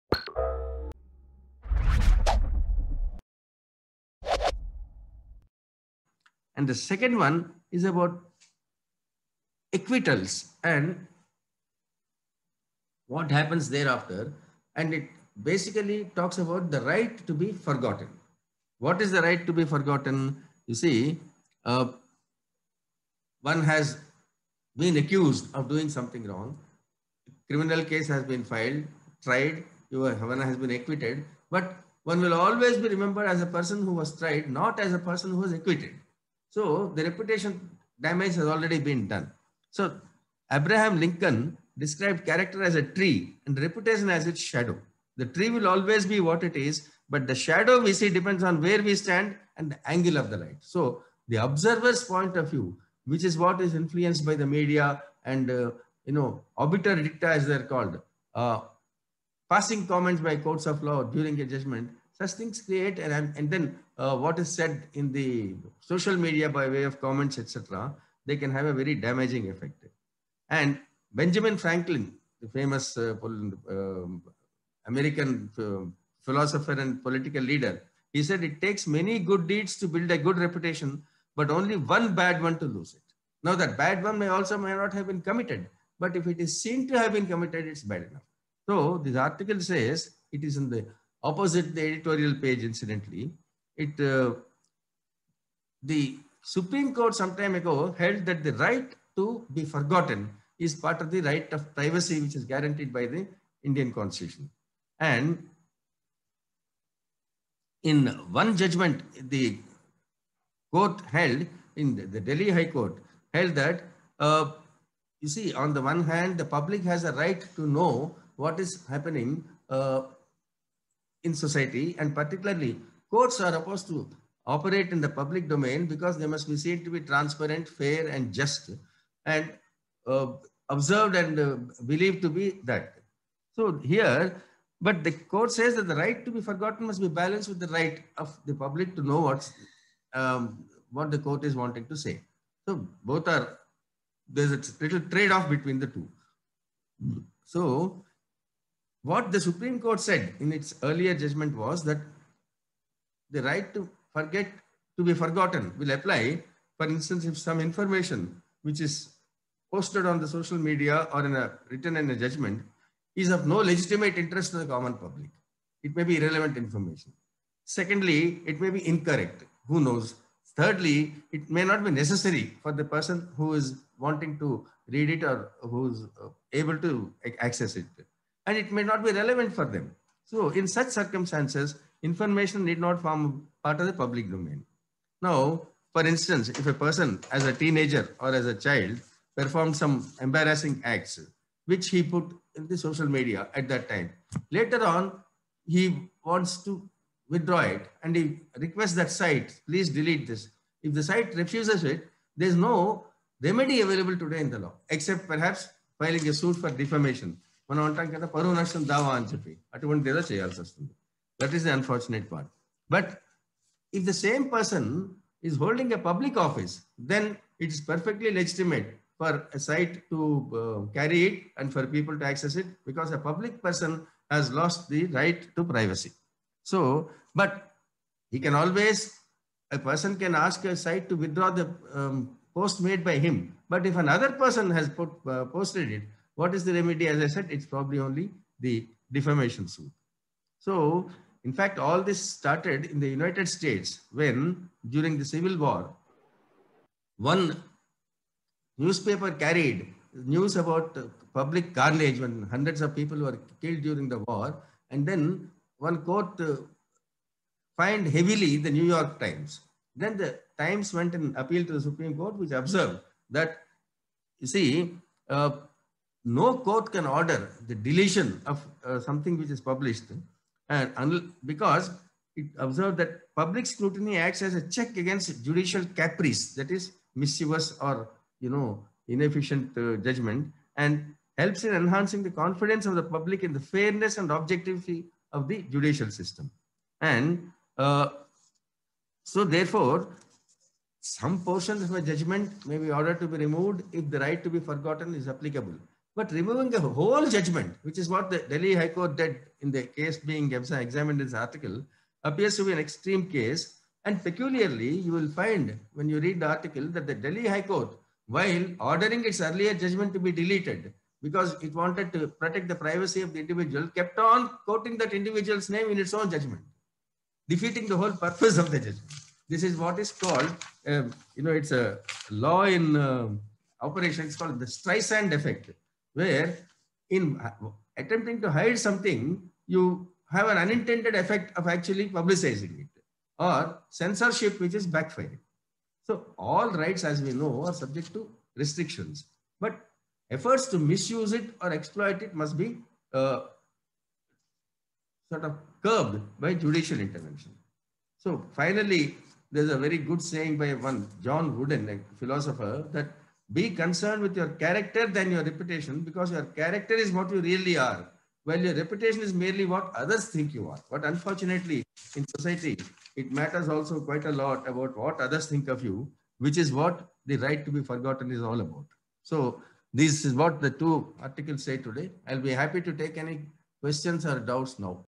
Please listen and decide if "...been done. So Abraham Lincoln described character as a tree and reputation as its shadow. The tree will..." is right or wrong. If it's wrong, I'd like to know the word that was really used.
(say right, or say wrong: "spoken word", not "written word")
right.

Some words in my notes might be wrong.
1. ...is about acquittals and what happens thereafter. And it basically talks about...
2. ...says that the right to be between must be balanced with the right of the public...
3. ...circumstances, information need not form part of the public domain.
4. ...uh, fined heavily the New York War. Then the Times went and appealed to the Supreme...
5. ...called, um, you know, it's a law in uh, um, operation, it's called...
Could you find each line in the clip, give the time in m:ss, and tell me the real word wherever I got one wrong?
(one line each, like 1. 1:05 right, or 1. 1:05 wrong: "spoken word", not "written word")
1. 0:07 right
2. 2:15 wrong: "forgotten", not "between"
3. 3:00 right
4. 4:16 wrong: "Times", not "War"
5. 5:20 right.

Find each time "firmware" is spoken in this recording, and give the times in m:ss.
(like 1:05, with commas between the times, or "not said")
not said.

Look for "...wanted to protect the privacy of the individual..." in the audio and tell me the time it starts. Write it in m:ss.
5:11.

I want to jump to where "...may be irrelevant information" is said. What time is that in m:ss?
2:45.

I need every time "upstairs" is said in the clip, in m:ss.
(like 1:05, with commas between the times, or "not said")
not said.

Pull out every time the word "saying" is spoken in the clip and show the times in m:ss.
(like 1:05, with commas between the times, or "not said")
5:50.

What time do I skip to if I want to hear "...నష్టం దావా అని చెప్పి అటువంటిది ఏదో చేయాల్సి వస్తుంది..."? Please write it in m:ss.
3:28.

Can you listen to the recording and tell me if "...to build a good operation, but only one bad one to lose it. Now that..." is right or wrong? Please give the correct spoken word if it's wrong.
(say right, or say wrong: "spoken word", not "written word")
wrong: "reputation", not "operation".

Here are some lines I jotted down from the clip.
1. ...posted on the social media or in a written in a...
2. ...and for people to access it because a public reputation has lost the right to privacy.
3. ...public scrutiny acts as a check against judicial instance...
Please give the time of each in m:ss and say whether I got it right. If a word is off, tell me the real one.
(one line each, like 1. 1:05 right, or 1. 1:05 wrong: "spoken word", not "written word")
1. 2:39 right
2. 3:41 wrong: "person", not "reputation"
3. 4:33 wrong: "caprice", not "instance".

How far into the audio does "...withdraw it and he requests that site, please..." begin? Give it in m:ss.
3:17.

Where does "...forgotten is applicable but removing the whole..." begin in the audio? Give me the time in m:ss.
4:54.